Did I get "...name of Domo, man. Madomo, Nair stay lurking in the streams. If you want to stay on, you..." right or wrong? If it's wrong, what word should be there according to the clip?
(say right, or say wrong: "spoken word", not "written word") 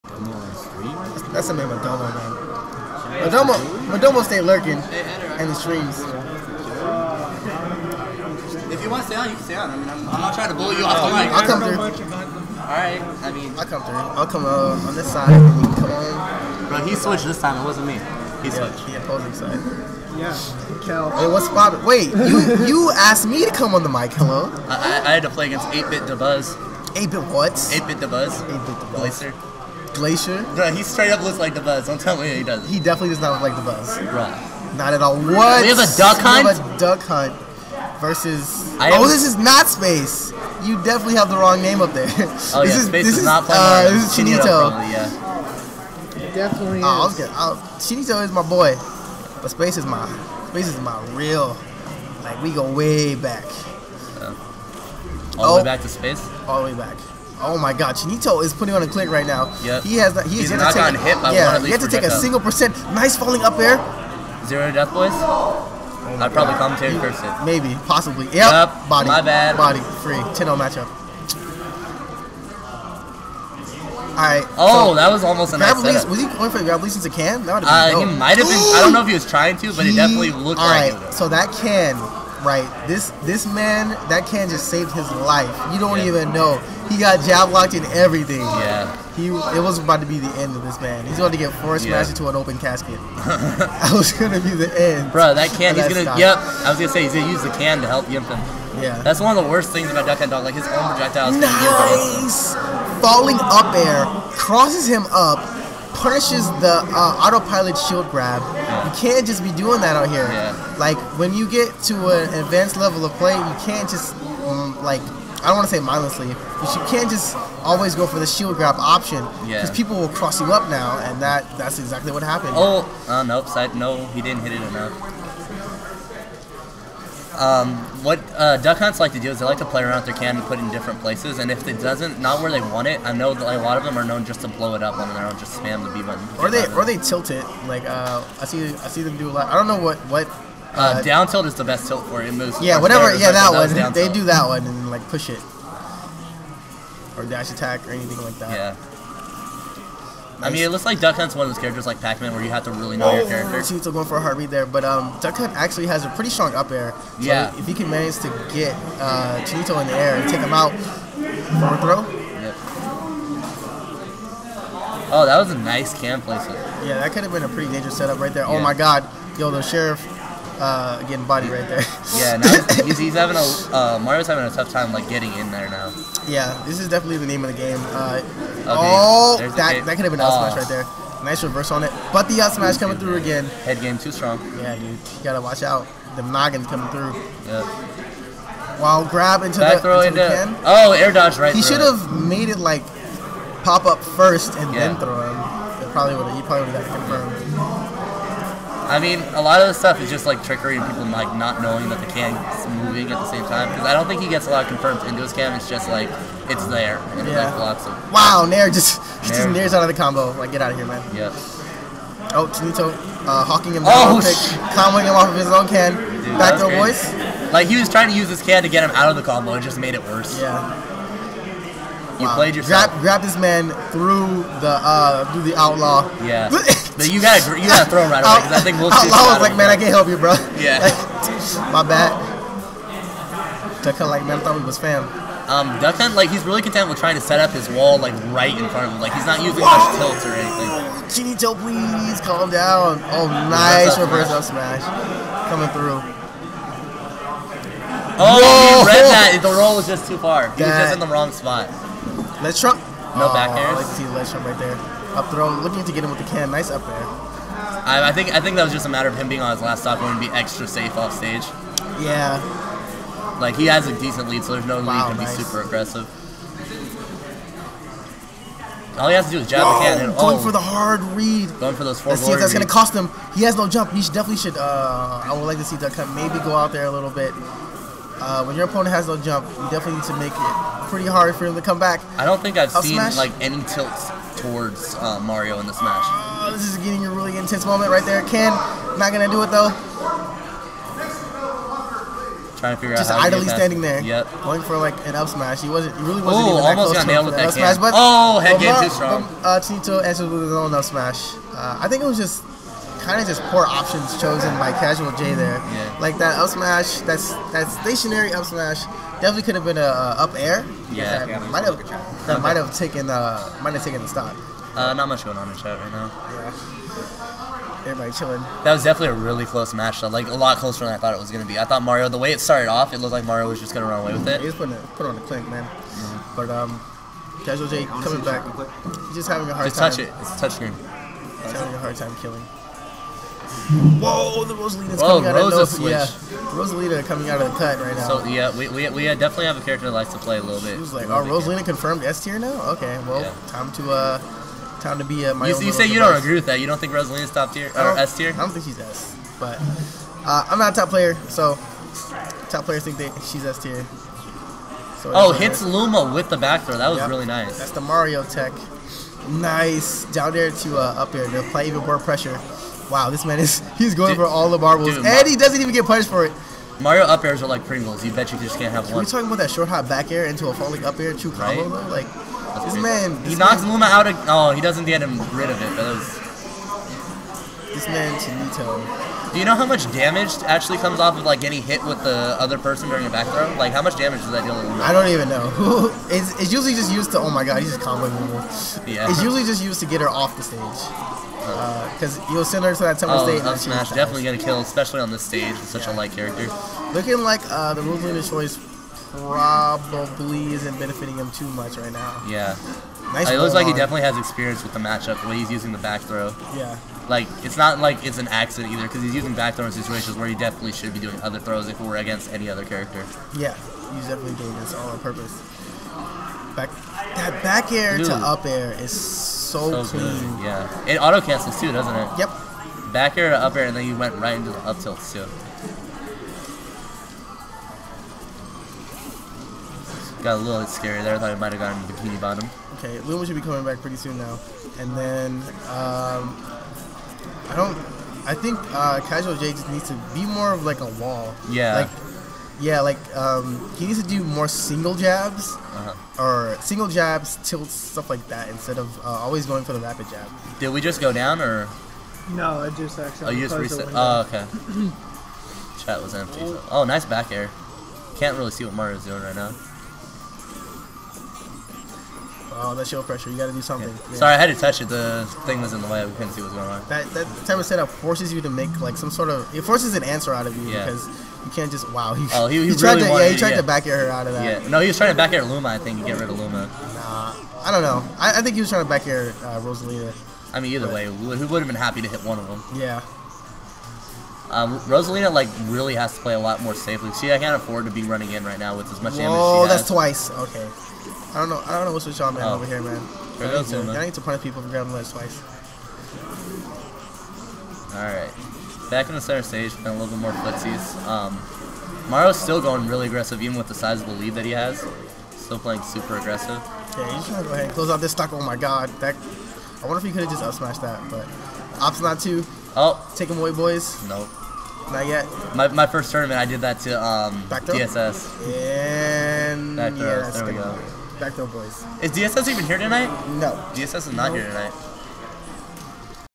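wrong: "Madomo", not "Nair".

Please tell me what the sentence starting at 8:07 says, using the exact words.
She I can't afford to be running in right now with as much Whoa, damage.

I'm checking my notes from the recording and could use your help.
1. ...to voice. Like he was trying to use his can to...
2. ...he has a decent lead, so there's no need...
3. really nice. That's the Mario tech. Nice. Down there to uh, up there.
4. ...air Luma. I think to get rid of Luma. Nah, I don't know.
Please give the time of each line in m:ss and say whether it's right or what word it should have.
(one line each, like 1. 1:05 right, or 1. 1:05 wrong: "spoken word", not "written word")
1. 3:36 right
2. 4:23 right
3. 5:57 right
4. 7:55 right.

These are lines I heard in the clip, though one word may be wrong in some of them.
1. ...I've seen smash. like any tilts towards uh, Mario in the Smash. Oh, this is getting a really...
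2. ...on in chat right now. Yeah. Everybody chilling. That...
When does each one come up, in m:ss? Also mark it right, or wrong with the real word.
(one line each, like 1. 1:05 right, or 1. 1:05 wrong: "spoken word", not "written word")
1. 4:42 right
2. 5:15 right.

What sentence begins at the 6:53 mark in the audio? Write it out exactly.
Yeah, he's definitely doing this all on purpose.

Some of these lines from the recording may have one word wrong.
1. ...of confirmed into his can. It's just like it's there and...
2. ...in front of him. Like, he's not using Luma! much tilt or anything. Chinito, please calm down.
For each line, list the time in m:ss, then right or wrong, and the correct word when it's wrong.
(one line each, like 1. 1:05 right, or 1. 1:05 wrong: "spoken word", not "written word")
1. 3:24 right
2. 3:58 wrong: "Whoa", not "Luma".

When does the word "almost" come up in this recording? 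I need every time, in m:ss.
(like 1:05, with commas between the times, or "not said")
1:15, 4:56.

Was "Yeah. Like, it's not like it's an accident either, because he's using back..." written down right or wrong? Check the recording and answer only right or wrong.
right.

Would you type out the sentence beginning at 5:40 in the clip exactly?
She was like, "Oh, Rosalina confirmed S tier now?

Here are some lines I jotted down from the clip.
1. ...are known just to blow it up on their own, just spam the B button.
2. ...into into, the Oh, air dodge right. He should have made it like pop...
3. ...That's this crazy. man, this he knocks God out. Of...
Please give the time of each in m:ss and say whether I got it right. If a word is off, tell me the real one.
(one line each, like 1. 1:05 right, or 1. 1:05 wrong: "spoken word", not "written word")
1. 2:13 right
2. 3:10 right
3. 6:12 wrong: "Luma", not "God".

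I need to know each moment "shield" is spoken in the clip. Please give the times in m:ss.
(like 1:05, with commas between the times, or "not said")
1:47, 1:58.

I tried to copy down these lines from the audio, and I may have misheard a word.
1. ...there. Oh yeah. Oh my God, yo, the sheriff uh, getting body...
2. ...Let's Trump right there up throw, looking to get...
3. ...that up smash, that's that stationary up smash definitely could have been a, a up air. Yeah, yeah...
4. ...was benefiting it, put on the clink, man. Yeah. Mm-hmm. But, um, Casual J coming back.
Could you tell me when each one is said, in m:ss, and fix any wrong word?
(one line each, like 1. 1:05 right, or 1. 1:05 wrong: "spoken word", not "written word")
1. 2:48 right
2. 4:14 right
3. 5:06 right
4. 5:24 wrong: "putting", not "benefiting".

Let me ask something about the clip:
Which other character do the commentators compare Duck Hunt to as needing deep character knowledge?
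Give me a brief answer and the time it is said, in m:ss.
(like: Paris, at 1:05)
Pac-Man, at 2:32.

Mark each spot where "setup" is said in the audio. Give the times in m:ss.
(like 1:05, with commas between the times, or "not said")
1:15, 2:47, 7:47.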